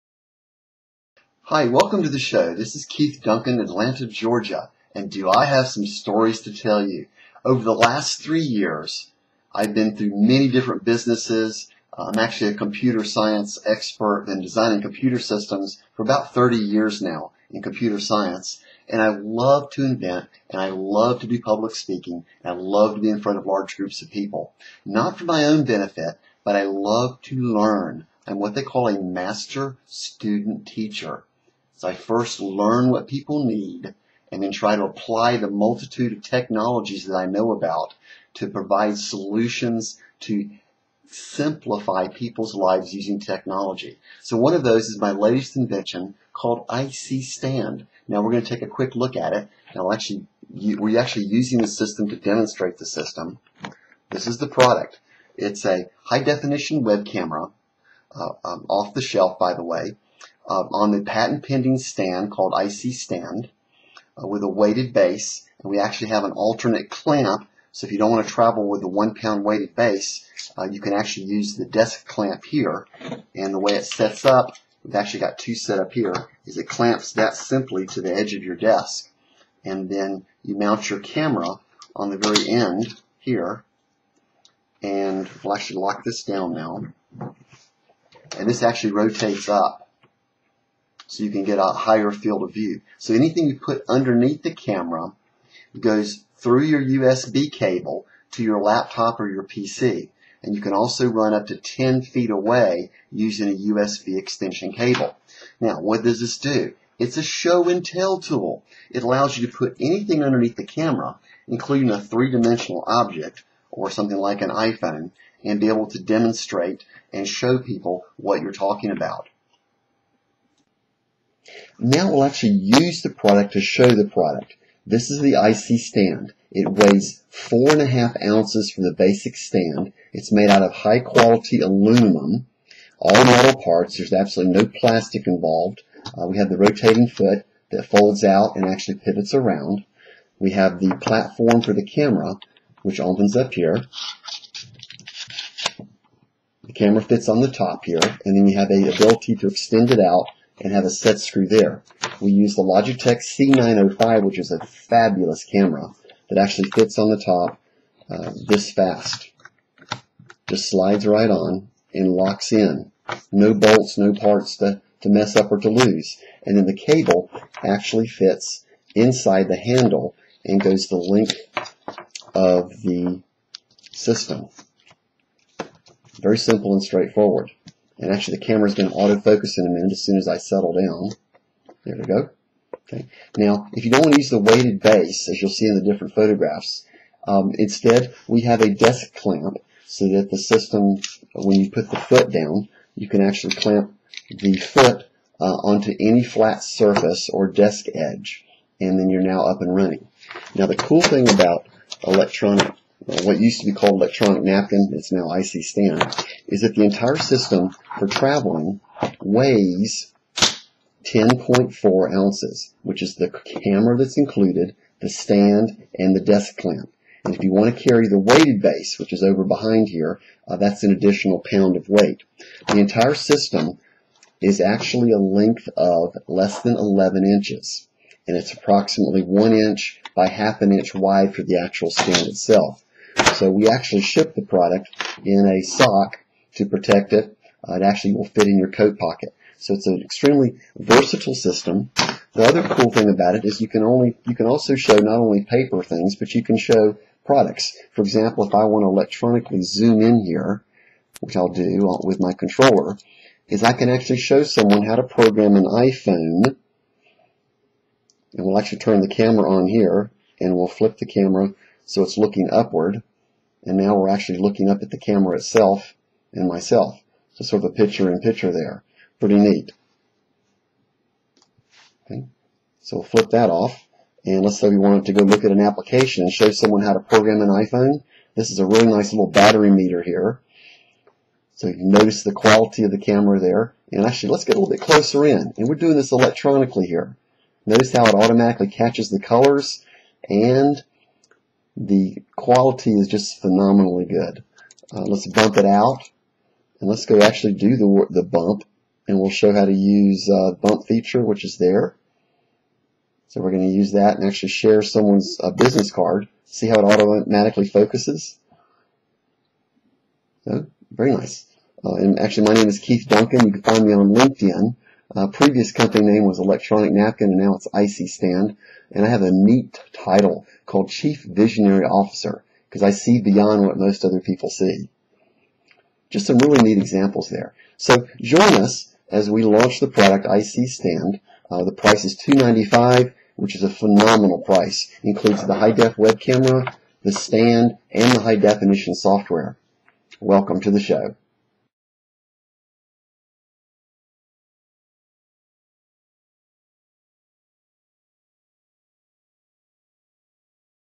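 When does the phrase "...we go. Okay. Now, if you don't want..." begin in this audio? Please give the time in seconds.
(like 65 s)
181 s.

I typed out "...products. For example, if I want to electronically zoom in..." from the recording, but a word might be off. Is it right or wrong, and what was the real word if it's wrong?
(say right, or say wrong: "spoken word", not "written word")
right.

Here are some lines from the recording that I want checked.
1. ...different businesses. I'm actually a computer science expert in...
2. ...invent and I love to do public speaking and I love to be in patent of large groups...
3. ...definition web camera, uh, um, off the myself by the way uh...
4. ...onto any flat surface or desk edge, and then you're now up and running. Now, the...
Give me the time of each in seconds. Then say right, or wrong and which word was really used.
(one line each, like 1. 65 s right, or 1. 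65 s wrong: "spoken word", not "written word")
1. 10 s right
2. 19 s wrong: "front", not "patent"
3. 56 s wrong: "shelf", not "myself"
4. 195 s right.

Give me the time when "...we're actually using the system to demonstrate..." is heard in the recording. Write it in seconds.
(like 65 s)
50 s.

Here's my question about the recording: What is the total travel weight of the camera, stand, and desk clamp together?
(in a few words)
10.4 ounces.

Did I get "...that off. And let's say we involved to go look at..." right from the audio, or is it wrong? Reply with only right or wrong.
wrong.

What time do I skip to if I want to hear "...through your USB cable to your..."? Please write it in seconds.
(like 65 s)
96 s.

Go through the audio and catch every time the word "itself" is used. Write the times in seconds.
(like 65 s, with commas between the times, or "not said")
232 s, 265 s.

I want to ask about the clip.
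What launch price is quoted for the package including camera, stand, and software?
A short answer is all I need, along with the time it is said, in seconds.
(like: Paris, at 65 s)
$295, at 332 s.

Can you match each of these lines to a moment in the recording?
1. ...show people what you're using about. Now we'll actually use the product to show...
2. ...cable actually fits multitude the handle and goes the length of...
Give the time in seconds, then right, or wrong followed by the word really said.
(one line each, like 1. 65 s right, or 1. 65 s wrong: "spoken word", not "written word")
1. 117 s wrong: "talking", not "using"
2. 166 s wrong: "inside", not "multitude".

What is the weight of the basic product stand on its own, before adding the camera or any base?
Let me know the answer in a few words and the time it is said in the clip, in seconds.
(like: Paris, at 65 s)
4.5 ounces, at 127 s.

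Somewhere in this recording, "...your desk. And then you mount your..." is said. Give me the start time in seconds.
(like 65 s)
78 s.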